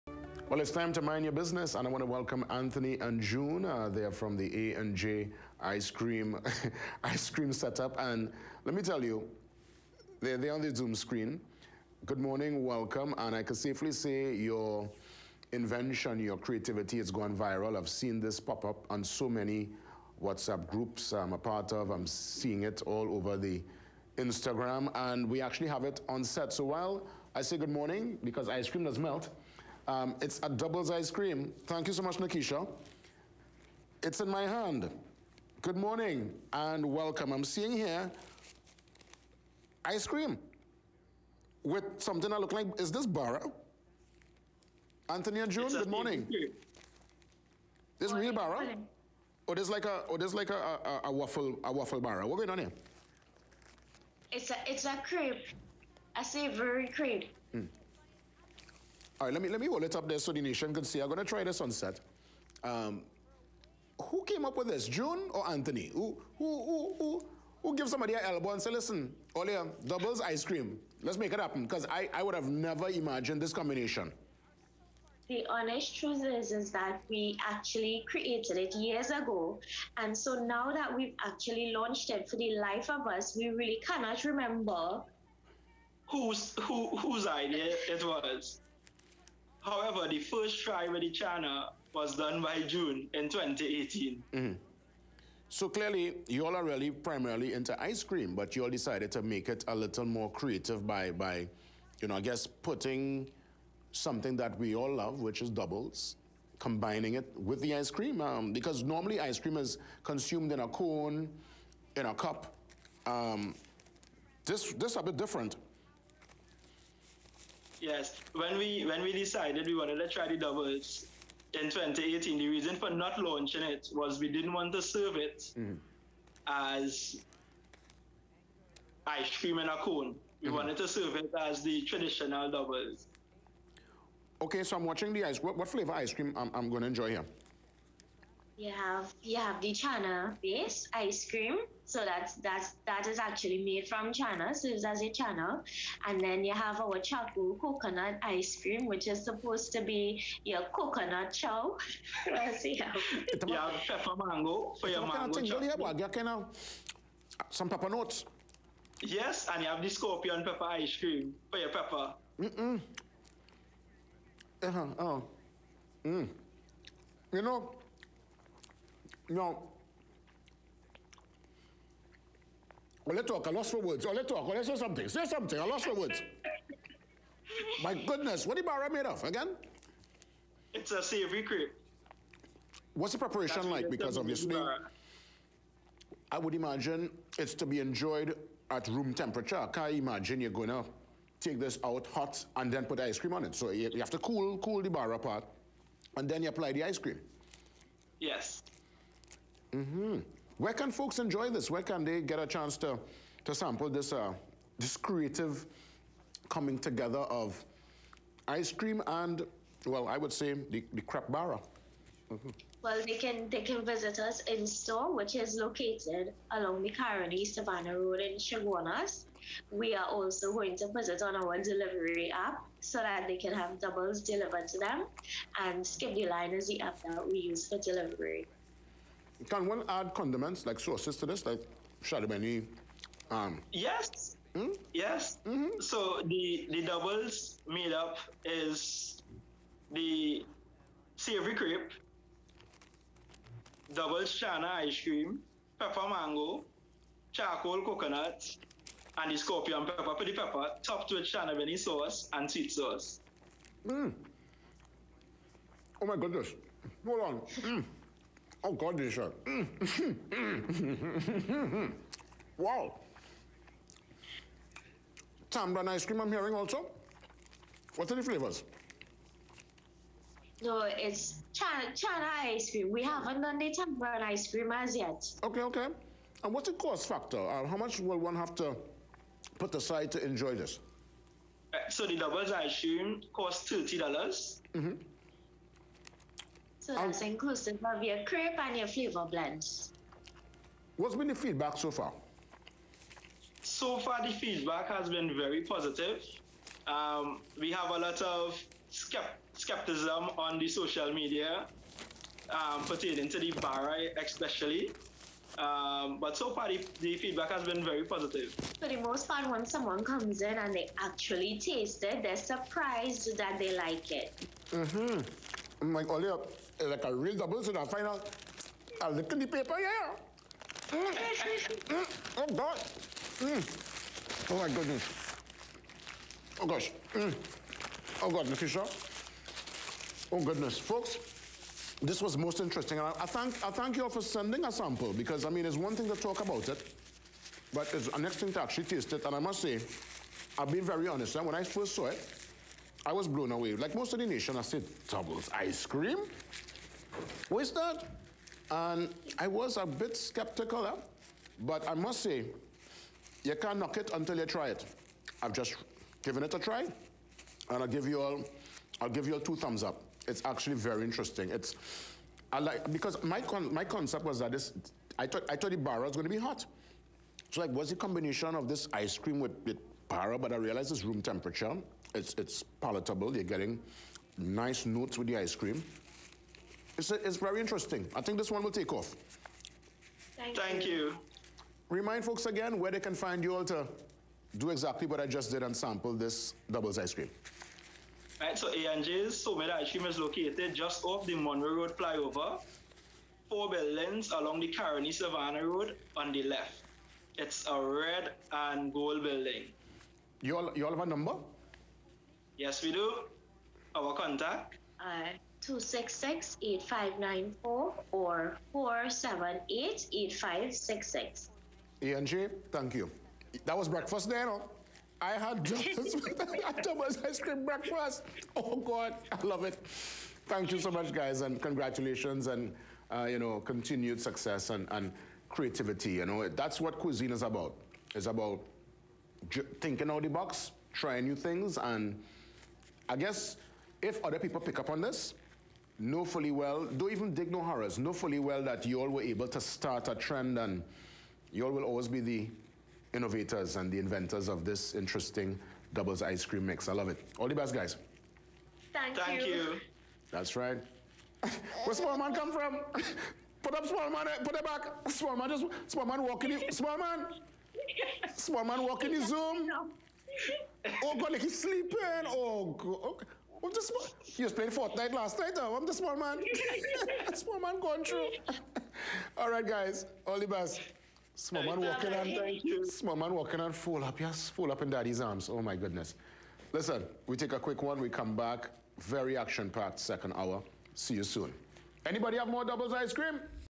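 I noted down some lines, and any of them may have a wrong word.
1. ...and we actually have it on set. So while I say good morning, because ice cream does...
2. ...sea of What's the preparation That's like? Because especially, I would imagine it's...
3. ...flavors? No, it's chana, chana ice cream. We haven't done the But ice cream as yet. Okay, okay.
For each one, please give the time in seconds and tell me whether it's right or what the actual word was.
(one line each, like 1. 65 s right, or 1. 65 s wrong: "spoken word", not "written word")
1. 25 s right
2. 181 s wrong: "obviously", not "especially"
3. 268 s wrong: "Tambran", not "But".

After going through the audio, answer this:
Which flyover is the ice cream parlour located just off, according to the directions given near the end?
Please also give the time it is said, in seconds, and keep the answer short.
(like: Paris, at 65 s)
Monroe Road flyover, at 391 s.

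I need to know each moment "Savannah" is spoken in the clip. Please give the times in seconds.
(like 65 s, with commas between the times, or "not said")
217 s, 395 s.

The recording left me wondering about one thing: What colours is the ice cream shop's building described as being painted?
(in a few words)
red and gold.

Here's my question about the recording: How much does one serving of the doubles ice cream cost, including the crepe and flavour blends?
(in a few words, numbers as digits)
$30.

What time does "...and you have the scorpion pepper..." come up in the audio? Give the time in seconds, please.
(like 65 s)
159 s.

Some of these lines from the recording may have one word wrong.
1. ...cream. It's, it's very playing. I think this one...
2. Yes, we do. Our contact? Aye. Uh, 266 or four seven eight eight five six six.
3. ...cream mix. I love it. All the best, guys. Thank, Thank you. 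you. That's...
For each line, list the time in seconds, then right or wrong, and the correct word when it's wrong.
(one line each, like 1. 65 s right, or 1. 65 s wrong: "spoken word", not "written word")
1. 375 s wrong: "interesting", not "playing"
2. 402 s right
3. 446 s right.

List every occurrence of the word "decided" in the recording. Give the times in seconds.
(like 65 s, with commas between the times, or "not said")
98 s, 119 s.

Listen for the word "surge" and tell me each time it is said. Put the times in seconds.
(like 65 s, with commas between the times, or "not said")
not said.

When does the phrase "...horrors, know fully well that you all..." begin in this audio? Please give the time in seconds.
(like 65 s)
437 s.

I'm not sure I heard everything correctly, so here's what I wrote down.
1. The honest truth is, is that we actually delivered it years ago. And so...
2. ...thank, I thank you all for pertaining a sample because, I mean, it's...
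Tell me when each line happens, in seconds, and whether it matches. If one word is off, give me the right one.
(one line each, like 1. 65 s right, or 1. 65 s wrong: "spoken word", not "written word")
1. 75 s wrong: "created", not "delivered"
2. 333 s wrong: "sending", not "pertaining".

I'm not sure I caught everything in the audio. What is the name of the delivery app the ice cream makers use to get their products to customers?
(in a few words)
Skip the Line.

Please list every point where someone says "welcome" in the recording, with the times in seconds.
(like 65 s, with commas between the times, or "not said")
2 s, 12 s, 36 s.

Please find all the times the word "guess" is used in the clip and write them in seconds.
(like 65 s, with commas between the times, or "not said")
102 s, 433 s.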